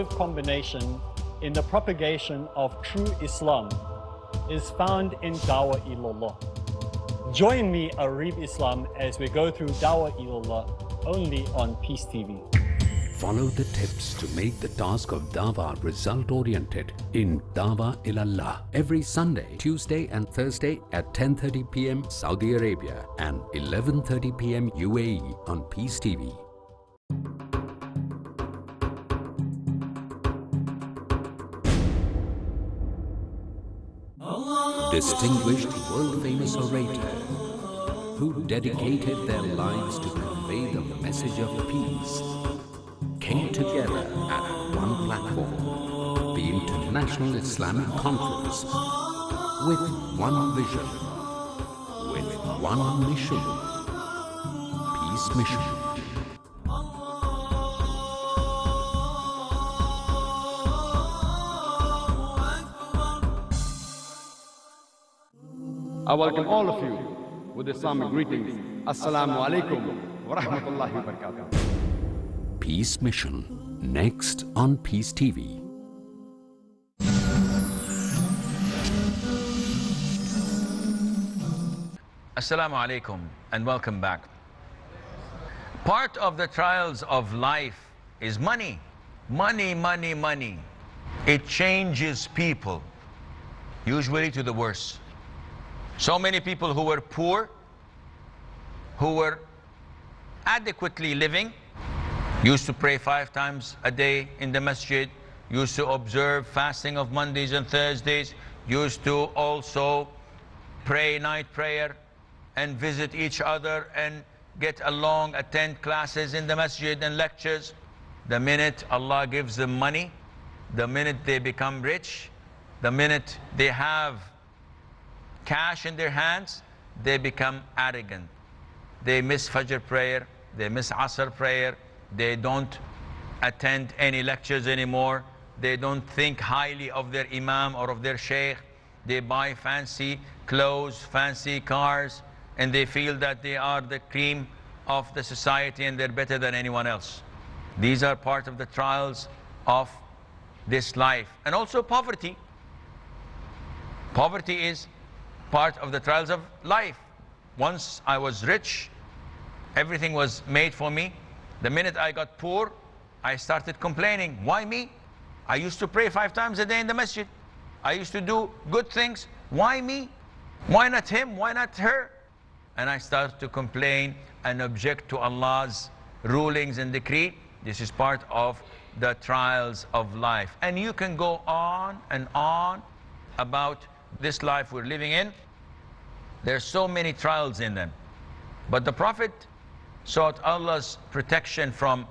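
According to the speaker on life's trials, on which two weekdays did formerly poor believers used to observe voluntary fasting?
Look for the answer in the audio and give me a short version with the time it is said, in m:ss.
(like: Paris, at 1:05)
Mondays and Thursdays, at 1:47.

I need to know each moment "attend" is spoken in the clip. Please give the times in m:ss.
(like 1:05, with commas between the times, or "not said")
1:55, 2:13.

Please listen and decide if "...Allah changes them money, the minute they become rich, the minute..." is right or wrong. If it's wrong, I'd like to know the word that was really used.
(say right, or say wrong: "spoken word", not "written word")
wrong: "gives", not "changes".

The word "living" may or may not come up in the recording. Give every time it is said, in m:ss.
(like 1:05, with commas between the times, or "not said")
1:41, 3:04.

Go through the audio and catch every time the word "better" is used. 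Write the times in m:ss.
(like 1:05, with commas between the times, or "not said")
2:26.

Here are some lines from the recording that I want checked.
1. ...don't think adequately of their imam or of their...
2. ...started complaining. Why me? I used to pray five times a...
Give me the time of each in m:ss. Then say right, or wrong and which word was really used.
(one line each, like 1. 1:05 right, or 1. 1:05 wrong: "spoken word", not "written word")
1. 2:15 wrong: "highly", not "adequately"
2. 2:43 right.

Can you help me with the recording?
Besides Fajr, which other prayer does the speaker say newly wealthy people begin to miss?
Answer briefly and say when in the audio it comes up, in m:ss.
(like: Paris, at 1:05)
Asr, at 2:10.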